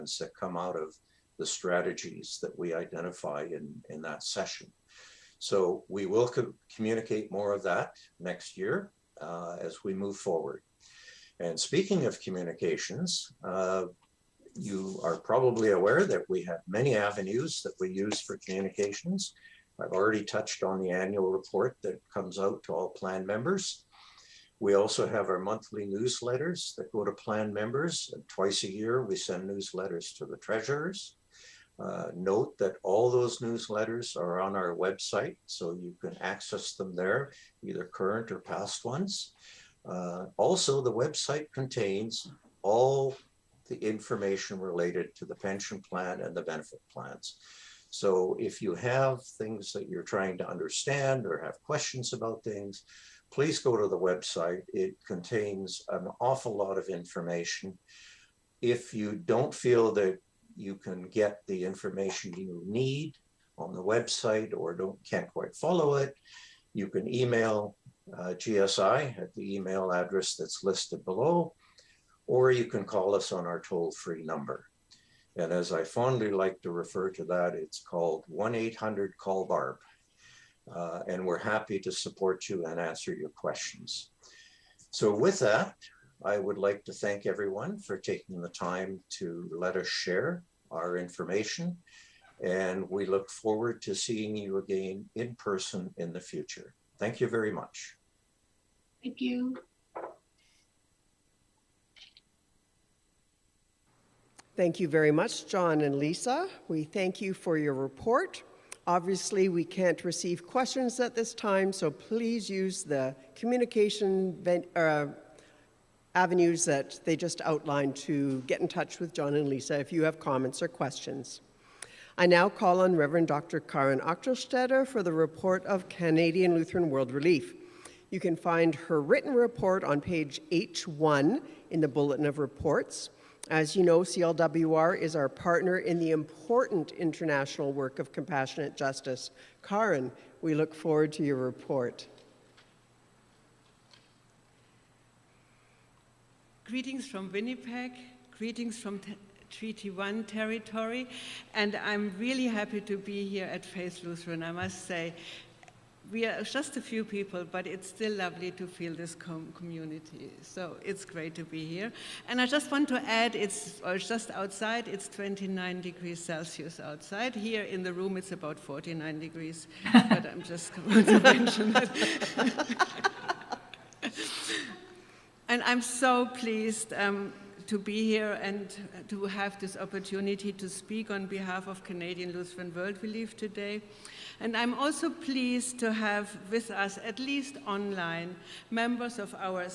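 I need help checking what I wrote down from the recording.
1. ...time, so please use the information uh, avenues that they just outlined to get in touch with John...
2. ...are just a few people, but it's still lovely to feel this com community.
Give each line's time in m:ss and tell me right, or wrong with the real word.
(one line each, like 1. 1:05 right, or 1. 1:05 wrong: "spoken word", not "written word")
1. 1:51 wrong: "communication", not "information"
2. 2:36 right.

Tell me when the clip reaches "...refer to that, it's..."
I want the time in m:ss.
1:16.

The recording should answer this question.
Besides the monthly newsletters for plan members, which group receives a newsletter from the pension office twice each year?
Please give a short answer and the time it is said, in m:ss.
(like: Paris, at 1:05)
Treasurers, at 0:30.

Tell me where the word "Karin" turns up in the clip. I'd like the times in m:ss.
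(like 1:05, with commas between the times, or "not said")
2:03, 2:19.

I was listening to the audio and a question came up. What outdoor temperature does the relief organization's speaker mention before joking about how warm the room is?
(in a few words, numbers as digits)
29 degrees Celsius.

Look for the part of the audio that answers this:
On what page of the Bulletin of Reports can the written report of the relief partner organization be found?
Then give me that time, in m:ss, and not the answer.
2:10.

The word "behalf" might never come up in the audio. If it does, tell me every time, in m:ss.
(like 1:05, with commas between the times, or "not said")
3:01.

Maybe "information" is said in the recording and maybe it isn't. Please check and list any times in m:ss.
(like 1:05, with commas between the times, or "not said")
0:43, 0:56, 1:01, 1:30.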